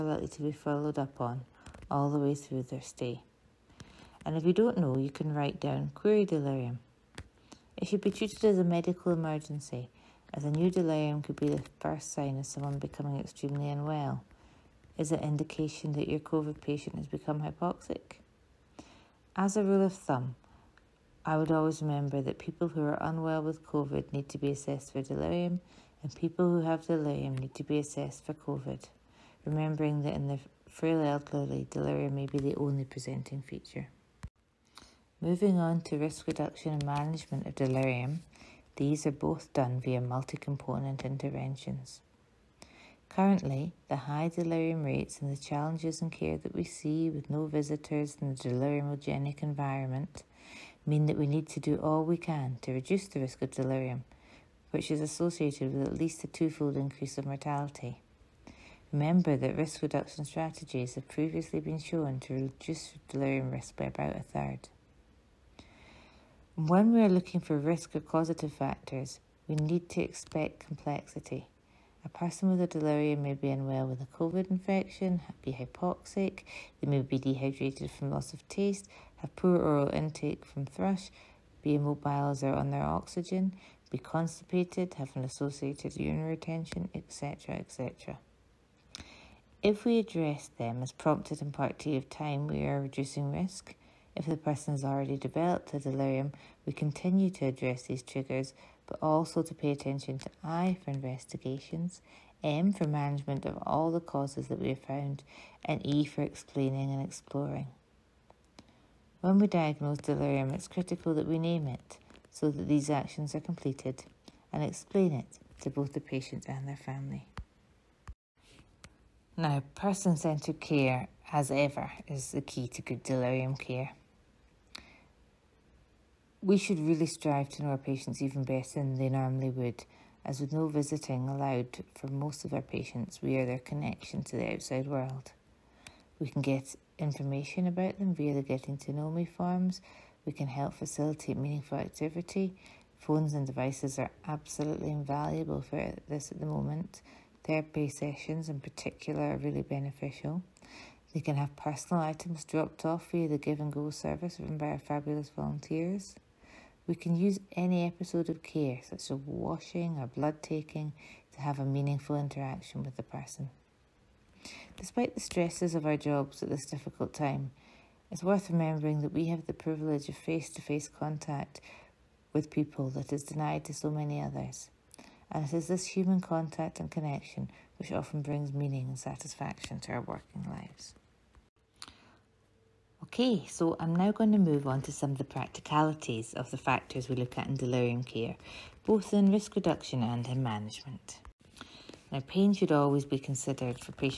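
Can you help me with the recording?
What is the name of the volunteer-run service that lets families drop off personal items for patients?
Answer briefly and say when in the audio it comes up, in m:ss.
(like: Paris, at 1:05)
Give and Go, at 2:33.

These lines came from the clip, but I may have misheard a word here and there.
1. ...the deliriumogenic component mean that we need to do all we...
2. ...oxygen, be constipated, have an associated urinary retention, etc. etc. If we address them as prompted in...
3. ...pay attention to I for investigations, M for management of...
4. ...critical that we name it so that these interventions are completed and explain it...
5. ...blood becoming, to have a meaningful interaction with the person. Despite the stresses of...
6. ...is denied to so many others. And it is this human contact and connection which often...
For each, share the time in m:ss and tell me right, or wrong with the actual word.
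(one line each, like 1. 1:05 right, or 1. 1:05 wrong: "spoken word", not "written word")
1. 0:48 wrong: "environment", not "component"
2. 1:22 right
3. 1:39 right
4. 1:50 wrong: "actions", not "interventions"
5. 2:40 wrong: "taking", not "becoming"
6. 2:53 right.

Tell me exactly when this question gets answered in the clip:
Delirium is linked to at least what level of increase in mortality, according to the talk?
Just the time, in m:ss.
0:56.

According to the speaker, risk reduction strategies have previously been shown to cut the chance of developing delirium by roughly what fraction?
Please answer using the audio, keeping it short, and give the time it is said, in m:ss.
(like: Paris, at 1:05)
a third, at 1:03.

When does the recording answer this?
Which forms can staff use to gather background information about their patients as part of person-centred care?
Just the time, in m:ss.
2:18.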